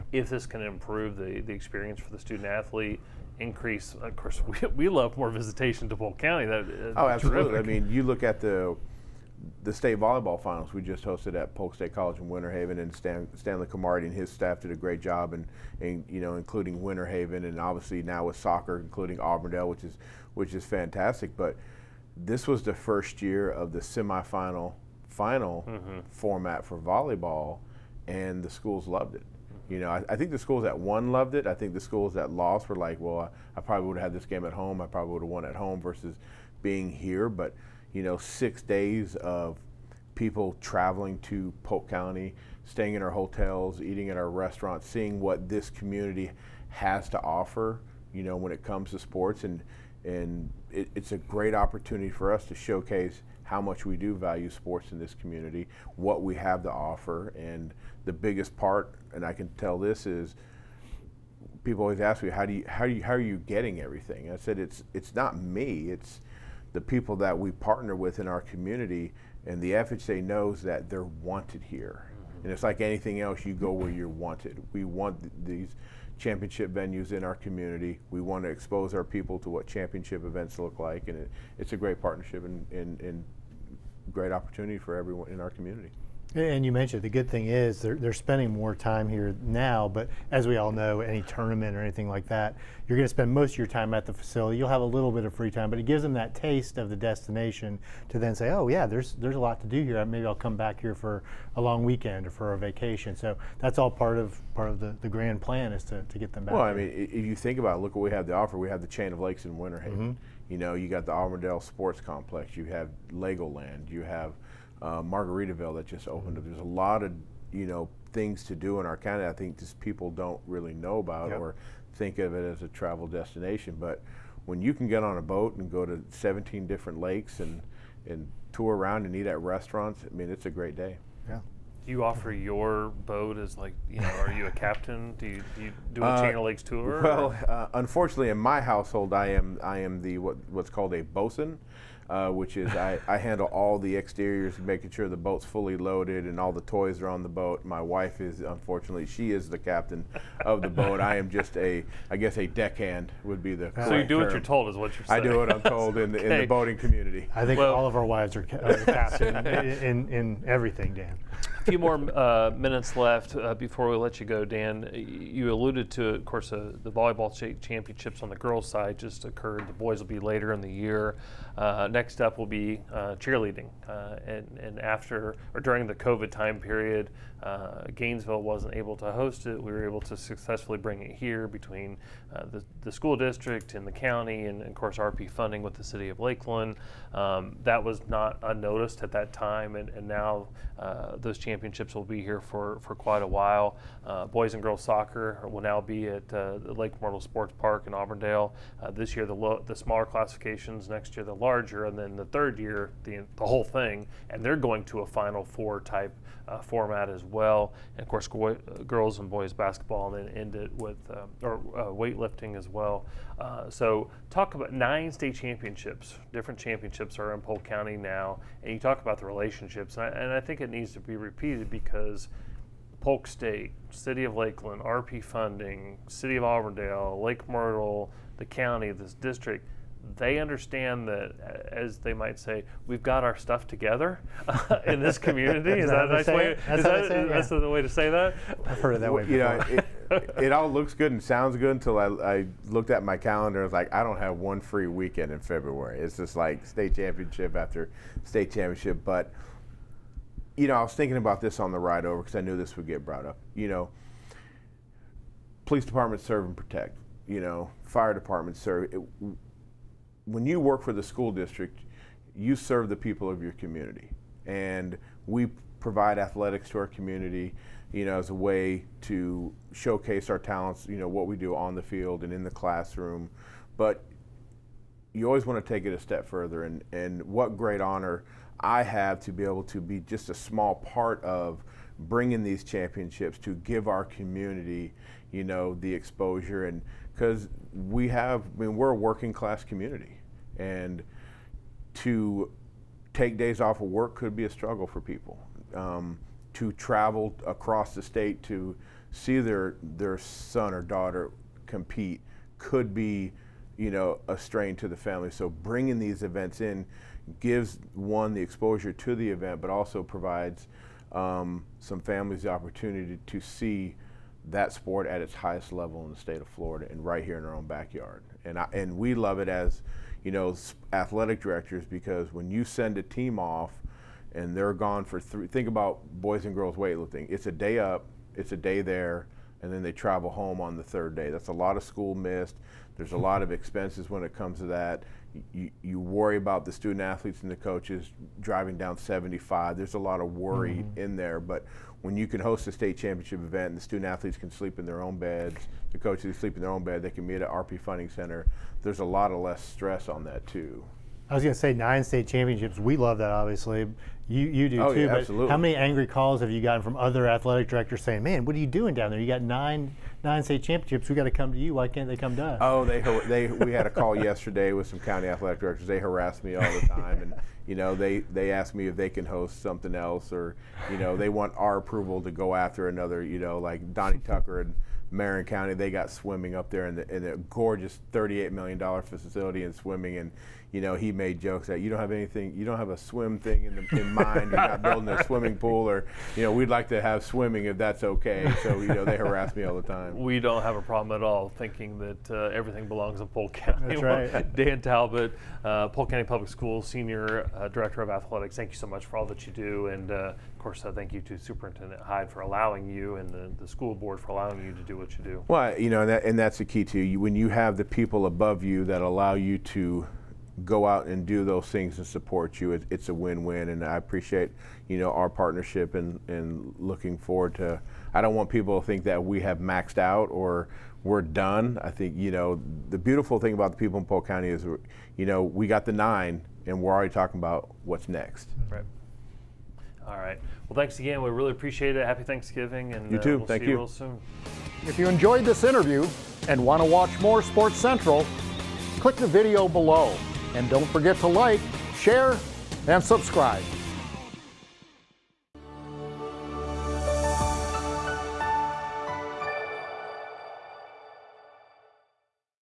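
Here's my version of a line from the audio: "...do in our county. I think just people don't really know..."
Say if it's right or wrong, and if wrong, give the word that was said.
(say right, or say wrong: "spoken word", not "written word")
right.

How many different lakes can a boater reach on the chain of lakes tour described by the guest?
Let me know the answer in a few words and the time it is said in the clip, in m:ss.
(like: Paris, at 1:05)
17, at 2:06.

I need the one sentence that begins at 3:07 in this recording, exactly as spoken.
Um, that was not unnoticed at that time, and, and now uh, those championships will be here for, for quite a while.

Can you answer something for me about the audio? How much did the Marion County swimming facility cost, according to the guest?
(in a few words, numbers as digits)
$38 million.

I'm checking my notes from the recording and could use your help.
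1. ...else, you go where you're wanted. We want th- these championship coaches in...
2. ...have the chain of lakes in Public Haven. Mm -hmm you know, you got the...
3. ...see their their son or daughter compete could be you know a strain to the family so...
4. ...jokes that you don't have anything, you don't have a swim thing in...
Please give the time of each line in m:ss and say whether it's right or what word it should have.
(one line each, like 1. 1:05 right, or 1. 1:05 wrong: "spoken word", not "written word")
1. 1:13 wrong: "venues", not "coaches"
2. 1:48 wrong: "Winter", not "Public"
3. 4:59 right
4. 6:21 right.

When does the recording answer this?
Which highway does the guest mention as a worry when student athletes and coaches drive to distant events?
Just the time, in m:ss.
5:38.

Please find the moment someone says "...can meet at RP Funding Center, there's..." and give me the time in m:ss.
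5:47.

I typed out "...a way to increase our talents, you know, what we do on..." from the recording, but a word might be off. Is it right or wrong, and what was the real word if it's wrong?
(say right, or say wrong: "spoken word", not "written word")
wrong: "showcase", not "increase".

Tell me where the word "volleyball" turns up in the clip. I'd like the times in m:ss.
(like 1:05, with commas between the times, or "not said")
0:09, 0:26, 2:46.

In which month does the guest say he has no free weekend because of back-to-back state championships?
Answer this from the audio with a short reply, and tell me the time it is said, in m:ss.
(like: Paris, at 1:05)
February, at 4:05.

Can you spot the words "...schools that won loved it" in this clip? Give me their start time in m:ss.
0:30.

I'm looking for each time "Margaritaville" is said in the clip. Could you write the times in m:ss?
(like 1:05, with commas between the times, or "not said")
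1:54.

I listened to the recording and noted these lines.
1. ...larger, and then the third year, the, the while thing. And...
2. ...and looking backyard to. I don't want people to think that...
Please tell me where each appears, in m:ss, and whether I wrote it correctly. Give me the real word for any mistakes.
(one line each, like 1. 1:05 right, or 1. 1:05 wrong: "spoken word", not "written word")
1. 3:21 wrong: "whole", not "while"
2. 6:56 wrong: "forward", not "backyard".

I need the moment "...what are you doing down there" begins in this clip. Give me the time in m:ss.
5:58.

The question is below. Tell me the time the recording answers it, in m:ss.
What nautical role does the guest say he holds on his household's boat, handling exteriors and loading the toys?
2:21.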